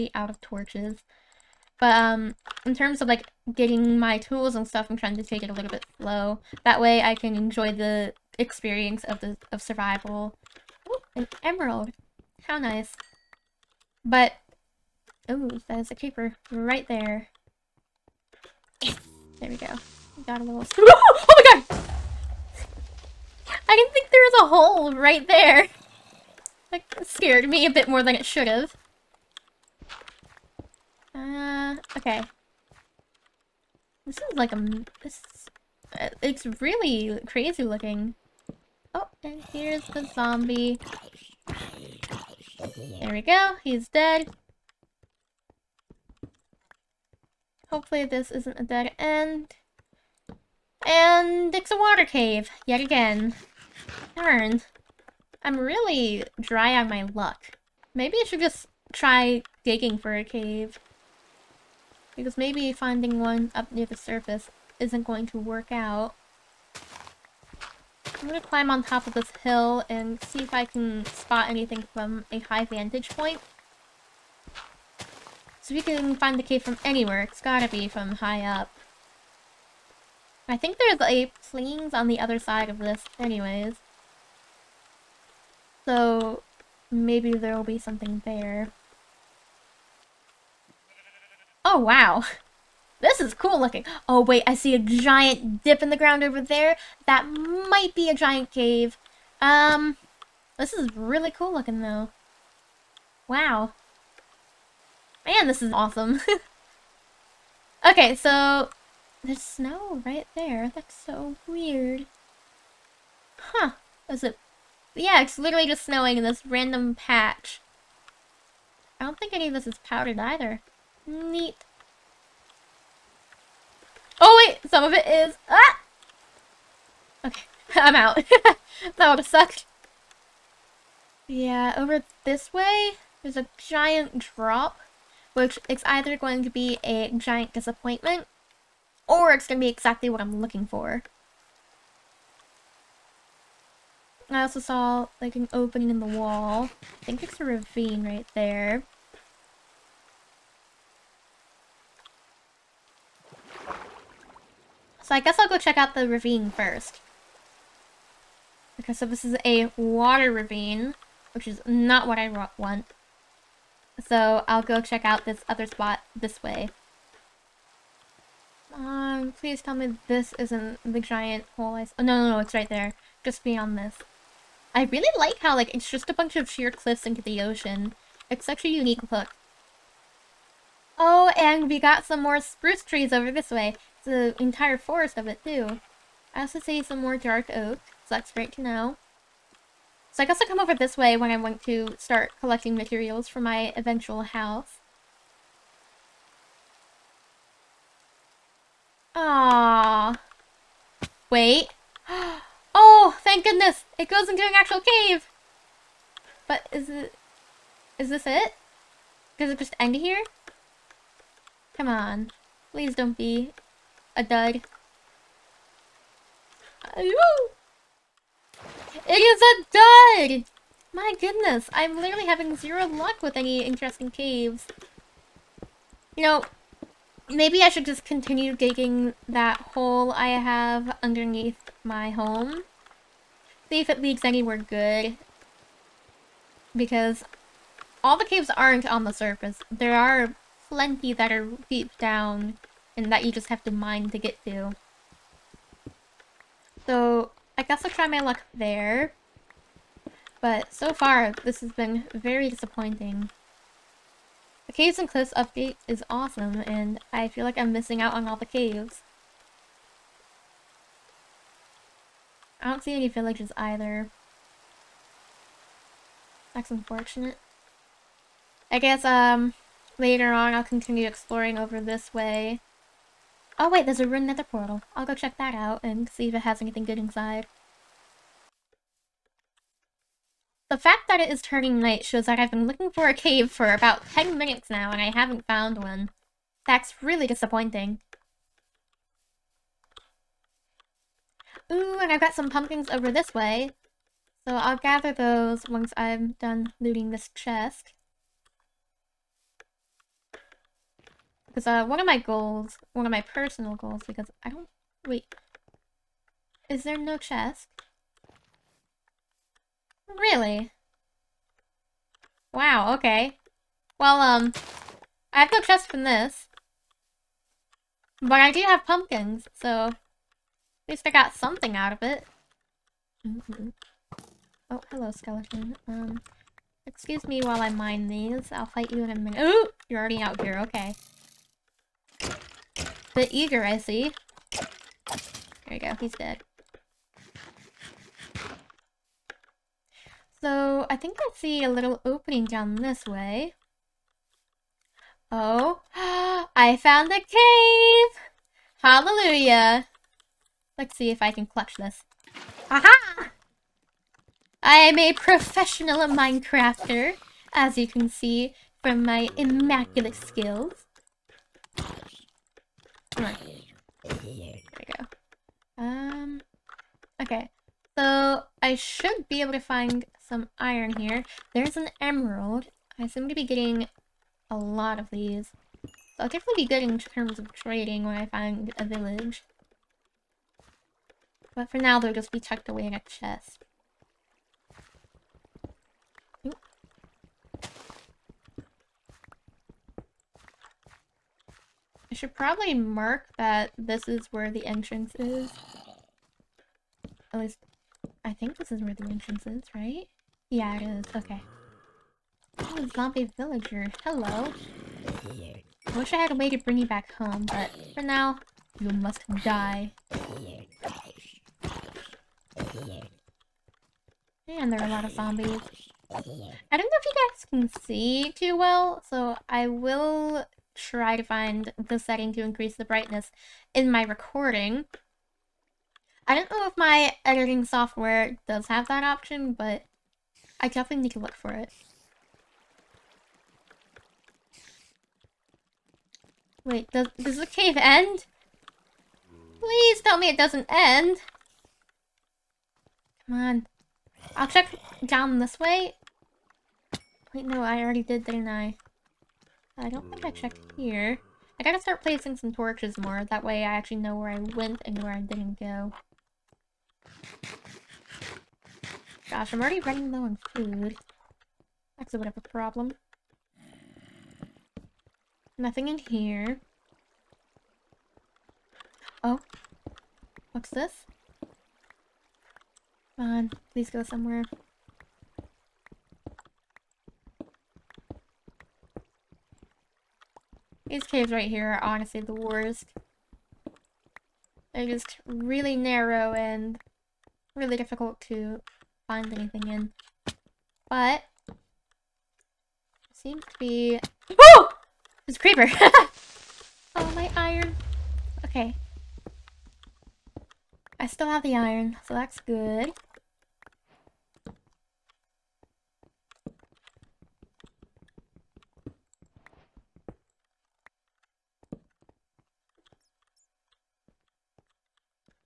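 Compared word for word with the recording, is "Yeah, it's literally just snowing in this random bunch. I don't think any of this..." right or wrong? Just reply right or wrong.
wrong.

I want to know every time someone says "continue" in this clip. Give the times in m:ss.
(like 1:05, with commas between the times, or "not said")
3:48, 4:30.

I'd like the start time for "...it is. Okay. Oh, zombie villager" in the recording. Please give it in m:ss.
6:40.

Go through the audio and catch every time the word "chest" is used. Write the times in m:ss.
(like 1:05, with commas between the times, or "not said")
4:57, 5:07, 5:15, 6:23.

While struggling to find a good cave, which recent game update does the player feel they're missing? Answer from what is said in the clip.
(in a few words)
Caves and Cliffs.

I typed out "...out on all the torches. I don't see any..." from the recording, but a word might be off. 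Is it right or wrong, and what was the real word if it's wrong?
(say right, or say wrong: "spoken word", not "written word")
wrong: "caves", not "torches".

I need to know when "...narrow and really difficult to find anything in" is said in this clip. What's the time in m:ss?
8:05.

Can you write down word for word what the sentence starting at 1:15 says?
So we can find the cave from anywhere, it's gotta be from high up.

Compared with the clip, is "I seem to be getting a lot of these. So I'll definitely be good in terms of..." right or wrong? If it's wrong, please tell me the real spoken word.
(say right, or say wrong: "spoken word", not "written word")
right.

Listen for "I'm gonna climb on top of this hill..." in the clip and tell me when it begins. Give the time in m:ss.
1:08.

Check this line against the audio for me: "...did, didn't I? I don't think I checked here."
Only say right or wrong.
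right.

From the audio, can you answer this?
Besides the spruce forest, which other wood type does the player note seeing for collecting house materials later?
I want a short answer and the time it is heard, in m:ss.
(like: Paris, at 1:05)
Dark oak, at 3:07.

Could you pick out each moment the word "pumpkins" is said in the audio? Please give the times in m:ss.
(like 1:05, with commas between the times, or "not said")
4:52, 5:18.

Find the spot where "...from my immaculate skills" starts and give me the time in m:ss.
5:58.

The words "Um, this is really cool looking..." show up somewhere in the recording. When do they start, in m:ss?
1:39.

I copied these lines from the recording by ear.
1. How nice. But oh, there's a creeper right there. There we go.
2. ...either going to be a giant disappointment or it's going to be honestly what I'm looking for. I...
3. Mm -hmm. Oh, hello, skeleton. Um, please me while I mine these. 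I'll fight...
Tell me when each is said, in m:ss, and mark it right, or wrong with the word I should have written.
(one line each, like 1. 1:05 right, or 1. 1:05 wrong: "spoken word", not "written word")
1. 0:12 right
2. 2:15 wrong: "exactly", not "honestly"
3. 5:23 wrong: "excuse", not "please".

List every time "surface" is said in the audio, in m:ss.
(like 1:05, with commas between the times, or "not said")
1:03, 3:59.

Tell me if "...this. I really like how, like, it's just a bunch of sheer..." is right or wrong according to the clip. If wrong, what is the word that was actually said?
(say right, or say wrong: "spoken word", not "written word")
right.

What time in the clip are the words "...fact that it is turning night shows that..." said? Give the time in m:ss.
4:40.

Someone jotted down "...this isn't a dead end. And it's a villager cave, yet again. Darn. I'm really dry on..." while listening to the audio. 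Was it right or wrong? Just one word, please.
wrong.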